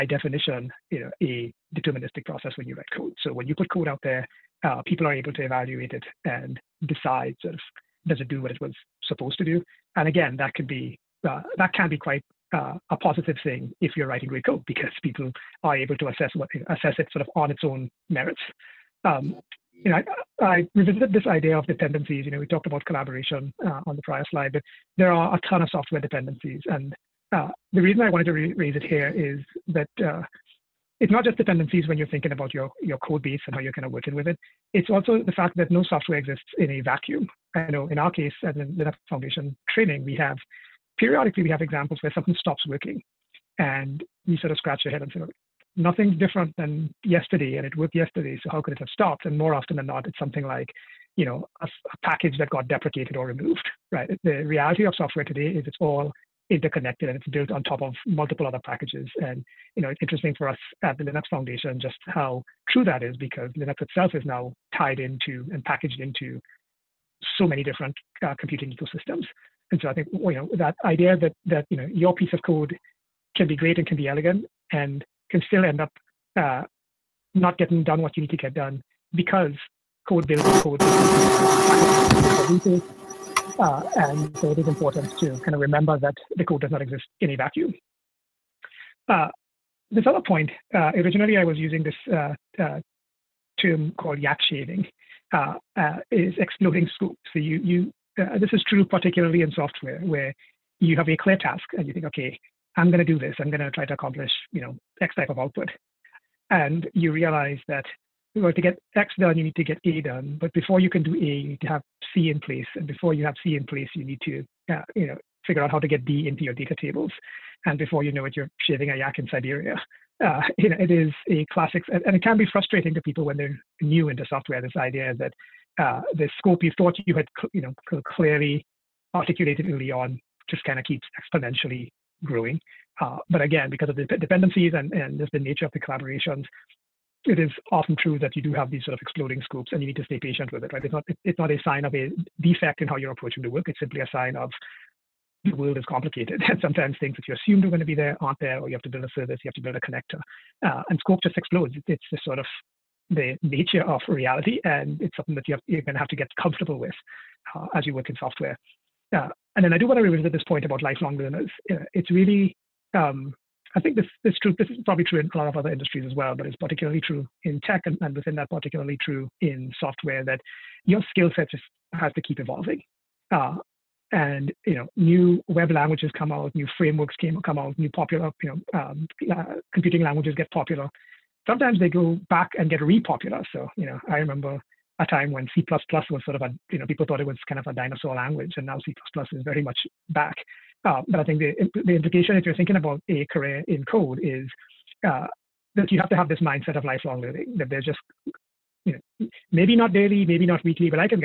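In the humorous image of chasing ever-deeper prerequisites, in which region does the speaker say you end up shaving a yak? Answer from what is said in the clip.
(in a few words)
Siberia.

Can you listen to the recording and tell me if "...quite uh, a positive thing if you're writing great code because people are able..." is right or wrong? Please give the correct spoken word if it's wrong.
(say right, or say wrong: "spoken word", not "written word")
right.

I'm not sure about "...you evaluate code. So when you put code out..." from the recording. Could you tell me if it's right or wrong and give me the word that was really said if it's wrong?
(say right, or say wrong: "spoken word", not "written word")
wrong: "write", not "evaluate".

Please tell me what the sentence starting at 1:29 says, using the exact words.
Uh, this other point, uh, originally I was using this uh, uh, term called yak shaving, uh, uh, is exploding scope.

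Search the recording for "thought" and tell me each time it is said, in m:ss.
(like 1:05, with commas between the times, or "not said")
2:06, 3:07.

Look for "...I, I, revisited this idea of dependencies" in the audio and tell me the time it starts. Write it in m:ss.
0:20.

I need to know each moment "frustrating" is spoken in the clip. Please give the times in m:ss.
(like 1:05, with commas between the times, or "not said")
2:02.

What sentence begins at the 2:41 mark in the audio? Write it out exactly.
Uh, it's really, um, I think this this true.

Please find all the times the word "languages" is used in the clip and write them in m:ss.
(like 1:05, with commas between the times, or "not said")
2:55, 3:00, 3:08.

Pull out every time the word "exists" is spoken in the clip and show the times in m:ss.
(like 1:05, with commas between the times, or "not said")
0:36, 1:26.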